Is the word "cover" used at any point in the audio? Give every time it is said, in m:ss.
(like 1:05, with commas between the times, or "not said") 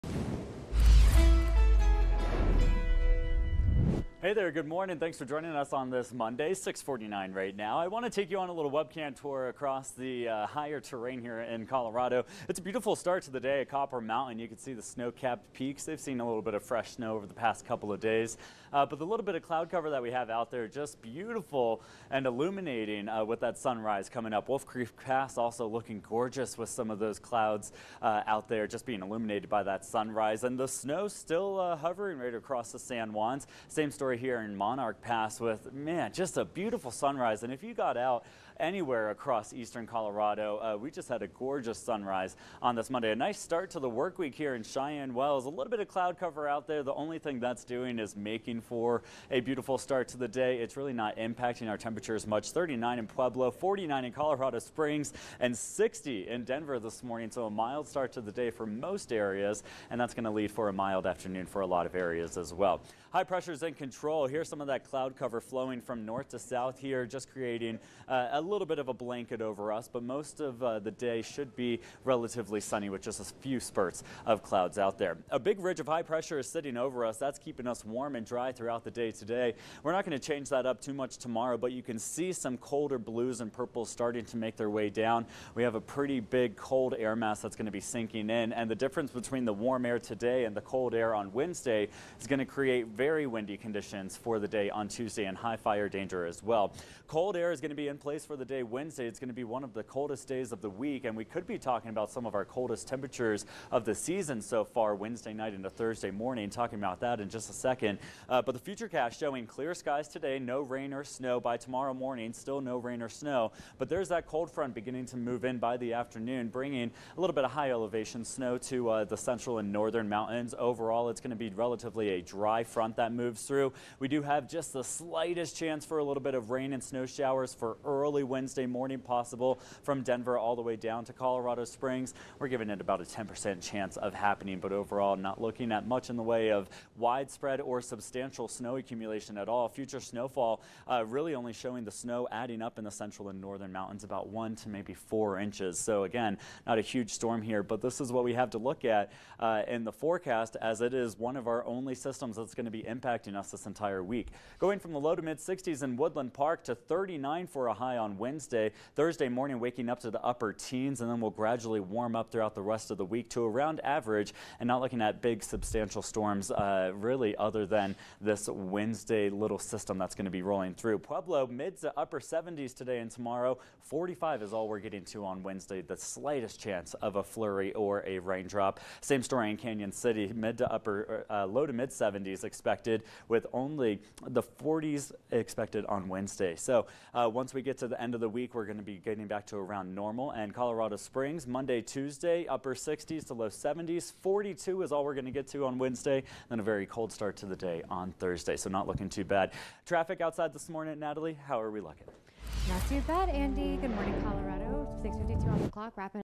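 0:19, 0:46, 1:05.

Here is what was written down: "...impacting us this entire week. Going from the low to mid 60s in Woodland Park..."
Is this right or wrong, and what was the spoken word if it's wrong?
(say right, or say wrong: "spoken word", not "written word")
right.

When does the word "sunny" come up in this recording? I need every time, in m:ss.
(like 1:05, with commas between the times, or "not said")
1:12.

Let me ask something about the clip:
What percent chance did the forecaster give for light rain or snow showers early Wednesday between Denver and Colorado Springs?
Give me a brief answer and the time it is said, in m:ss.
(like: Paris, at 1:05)
10%, at 2:13.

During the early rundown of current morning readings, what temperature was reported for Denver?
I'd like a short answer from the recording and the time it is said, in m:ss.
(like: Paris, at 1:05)
60, at 0:55.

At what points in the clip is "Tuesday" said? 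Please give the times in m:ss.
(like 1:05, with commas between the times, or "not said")
1:34, 3:11.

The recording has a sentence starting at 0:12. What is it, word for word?
It's a beautiful start to the day at Copper Mountain.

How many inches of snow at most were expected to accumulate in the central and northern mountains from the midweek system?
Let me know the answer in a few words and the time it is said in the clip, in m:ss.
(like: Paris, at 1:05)
4 inches, at 2:24.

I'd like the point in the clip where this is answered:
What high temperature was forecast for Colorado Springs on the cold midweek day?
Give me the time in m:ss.
3:14.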